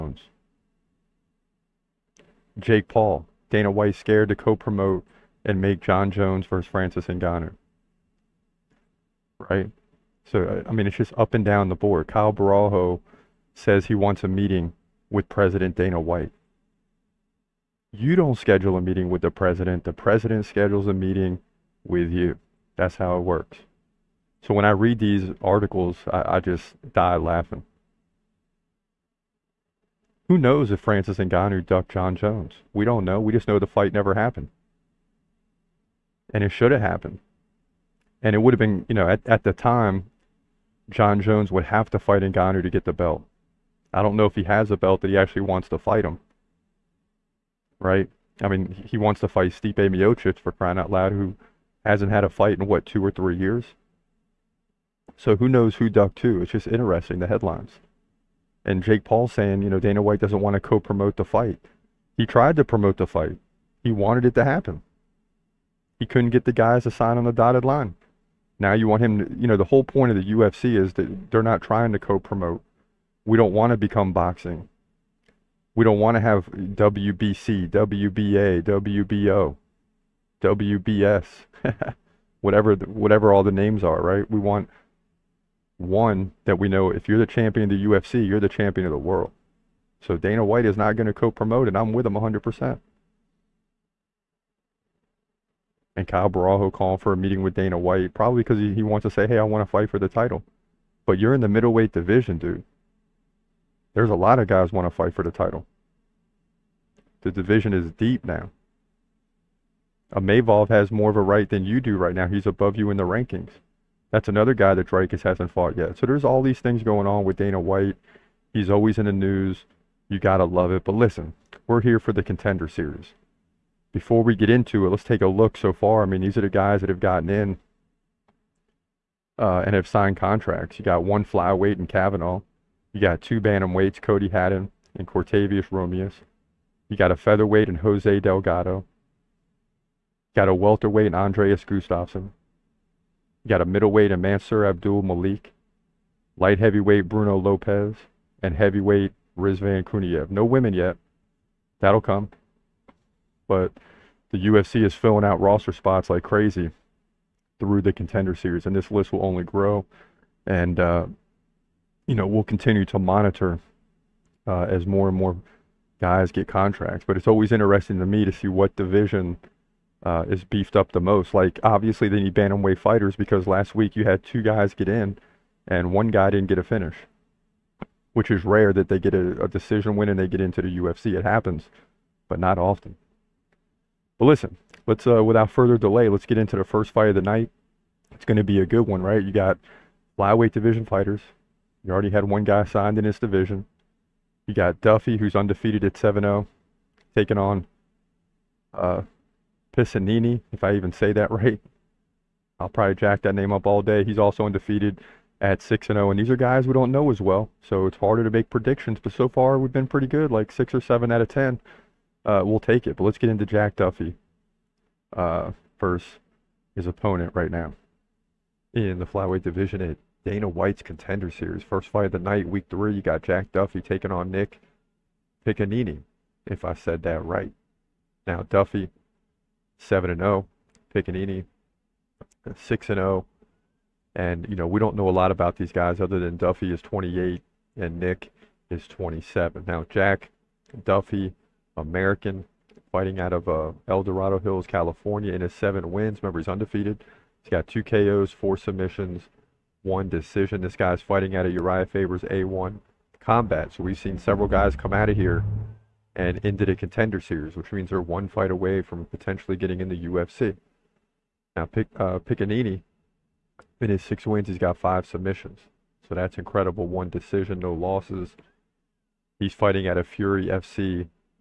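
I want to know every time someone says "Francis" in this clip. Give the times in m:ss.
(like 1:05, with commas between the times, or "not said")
0:06, 0:30.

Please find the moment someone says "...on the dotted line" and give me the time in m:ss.
1:07.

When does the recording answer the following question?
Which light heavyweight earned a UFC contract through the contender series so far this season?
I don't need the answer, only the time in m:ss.
2:27.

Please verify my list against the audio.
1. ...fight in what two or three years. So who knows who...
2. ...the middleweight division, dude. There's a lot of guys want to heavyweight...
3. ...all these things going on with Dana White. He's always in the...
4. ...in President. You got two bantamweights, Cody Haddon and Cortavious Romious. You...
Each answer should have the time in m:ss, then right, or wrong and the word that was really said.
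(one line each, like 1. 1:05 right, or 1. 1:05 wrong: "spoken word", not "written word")
1. 0:52 right
2. 1:41 wrong: "fight", not "heavyweight"
3. 1:56 right
4. 2:11 wrong: "Kavanaugh", not "President".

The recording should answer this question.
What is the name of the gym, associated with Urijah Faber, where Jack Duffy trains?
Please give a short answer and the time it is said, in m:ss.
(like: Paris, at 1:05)
A1 combat, at 4:12.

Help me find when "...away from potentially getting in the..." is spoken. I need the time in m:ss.
4:18.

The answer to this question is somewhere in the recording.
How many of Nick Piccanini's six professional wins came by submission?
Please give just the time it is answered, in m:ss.
4:24.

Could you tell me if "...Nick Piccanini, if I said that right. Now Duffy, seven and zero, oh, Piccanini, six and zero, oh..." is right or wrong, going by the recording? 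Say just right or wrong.
right.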